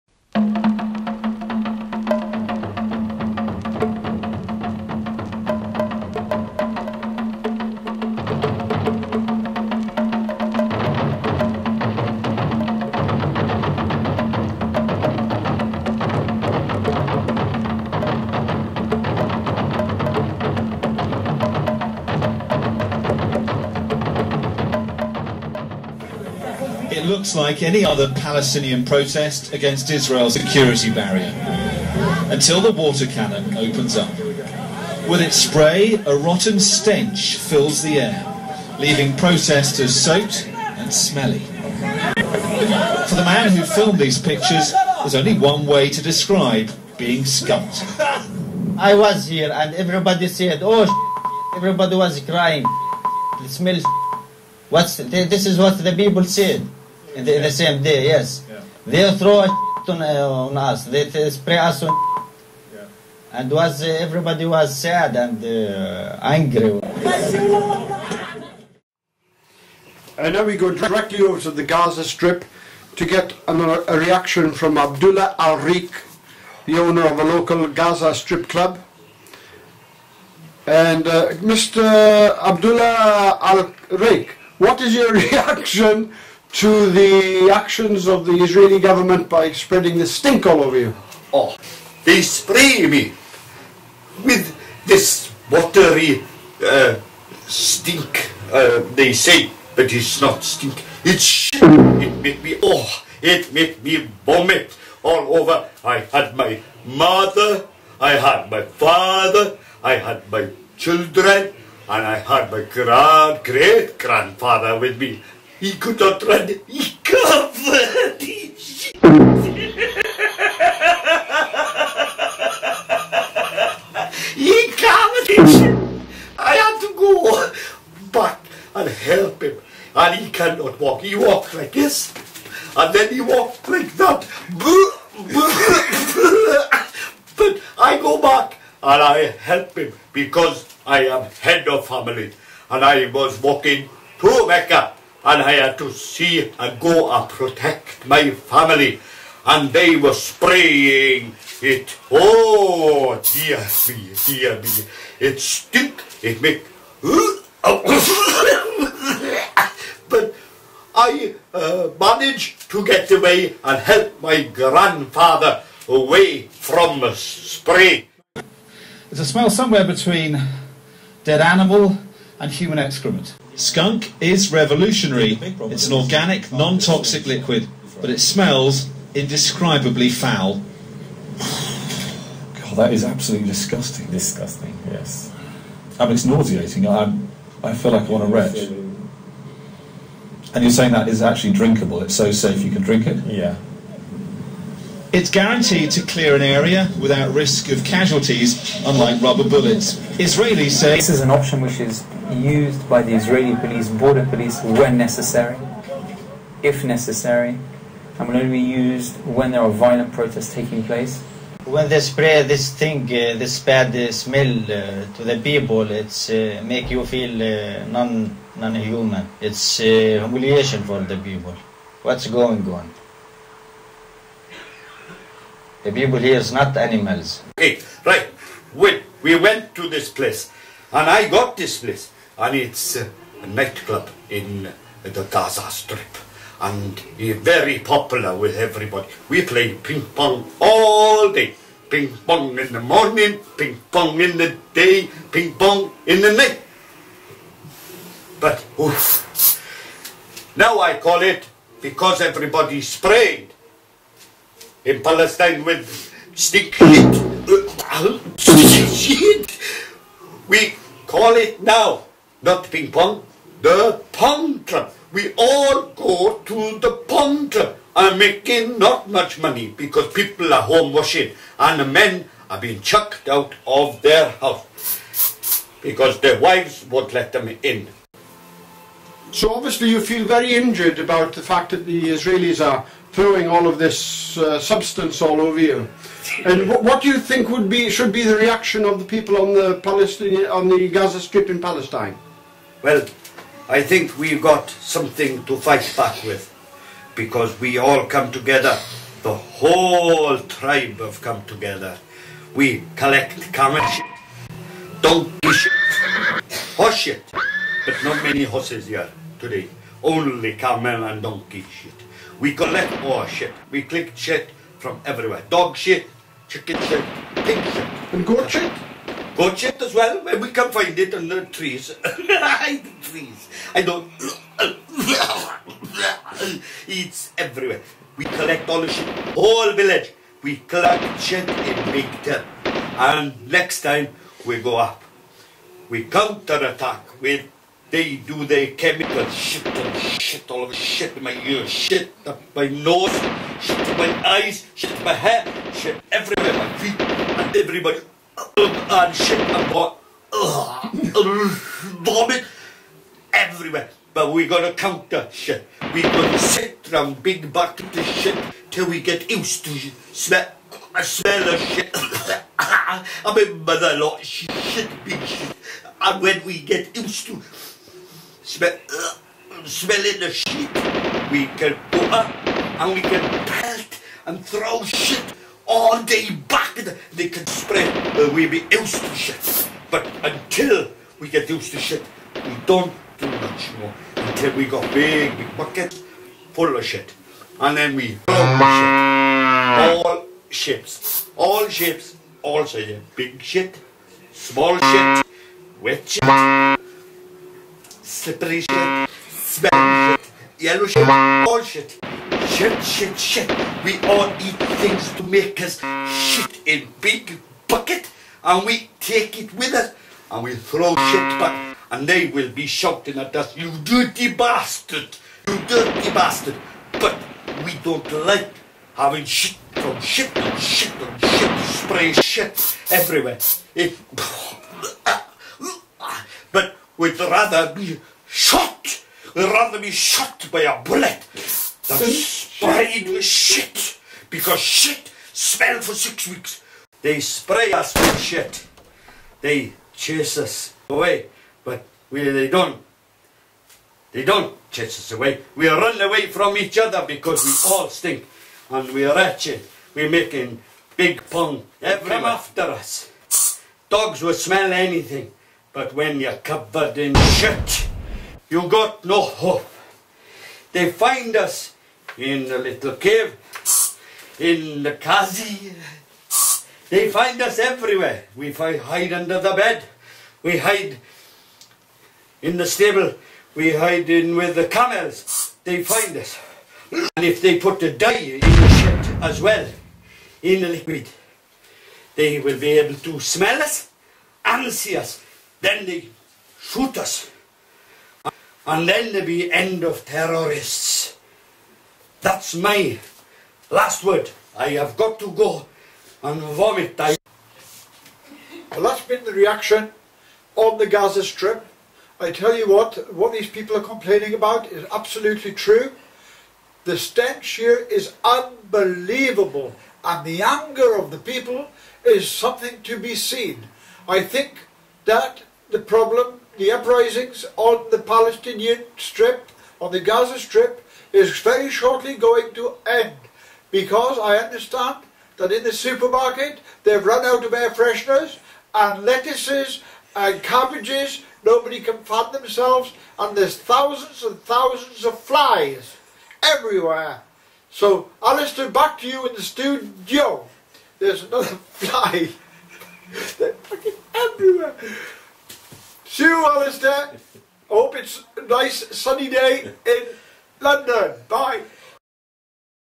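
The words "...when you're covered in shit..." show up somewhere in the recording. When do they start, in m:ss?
7:35.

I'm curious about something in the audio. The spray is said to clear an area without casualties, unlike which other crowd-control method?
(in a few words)
rubber bullets.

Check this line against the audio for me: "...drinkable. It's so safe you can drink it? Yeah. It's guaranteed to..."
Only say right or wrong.
right.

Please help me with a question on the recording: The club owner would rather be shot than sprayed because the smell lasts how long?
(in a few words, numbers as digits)
6 weeks.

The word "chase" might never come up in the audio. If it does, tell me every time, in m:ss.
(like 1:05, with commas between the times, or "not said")
7:19, 7:24.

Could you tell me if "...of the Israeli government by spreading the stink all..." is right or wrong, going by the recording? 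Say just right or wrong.
right.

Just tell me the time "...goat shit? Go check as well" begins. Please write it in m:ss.
5:18.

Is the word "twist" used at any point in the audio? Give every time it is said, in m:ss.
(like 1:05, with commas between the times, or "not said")
not said.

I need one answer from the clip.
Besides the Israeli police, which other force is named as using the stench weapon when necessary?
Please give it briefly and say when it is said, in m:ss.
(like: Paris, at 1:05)
border police, at 3:23.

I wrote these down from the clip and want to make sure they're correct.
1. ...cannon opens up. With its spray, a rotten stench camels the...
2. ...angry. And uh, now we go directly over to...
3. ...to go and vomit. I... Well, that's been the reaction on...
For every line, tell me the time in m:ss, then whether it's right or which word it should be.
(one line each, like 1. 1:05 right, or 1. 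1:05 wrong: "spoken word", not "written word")
1. 0:33 wrong: "fills", not "camels"
2. 1:06 right
3. 8:15 right.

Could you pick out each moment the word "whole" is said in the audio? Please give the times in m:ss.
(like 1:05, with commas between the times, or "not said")
4:59, 5:29.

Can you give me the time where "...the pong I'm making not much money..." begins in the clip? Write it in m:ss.
4:26.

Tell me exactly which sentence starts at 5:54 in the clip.
But we're going to counter shit.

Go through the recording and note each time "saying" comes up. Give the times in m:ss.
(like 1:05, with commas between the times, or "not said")
3:10.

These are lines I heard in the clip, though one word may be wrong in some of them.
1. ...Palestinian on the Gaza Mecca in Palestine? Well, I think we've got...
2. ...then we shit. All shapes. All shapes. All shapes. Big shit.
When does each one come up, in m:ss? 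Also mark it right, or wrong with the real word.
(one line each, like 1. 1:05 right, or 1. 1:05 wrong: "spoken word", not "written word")
1. 4:49 wrong: "Strip", not "Mecca"
2. 6:27 right.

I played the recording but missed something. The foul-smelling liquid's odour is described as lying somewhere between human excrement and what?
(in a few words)
dead animal.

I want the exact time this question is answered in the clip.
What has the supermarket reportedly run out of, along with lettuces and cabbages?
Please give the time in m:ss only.
8:47.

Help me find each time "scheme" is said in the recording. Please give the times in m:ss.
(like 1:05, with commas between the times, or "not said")
not said.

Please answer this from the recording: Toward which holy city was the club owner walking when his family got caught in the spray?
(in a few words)
Mecca.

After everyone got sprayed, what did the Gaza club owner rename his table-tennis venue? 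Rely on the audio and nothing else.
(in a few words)
the pong trap.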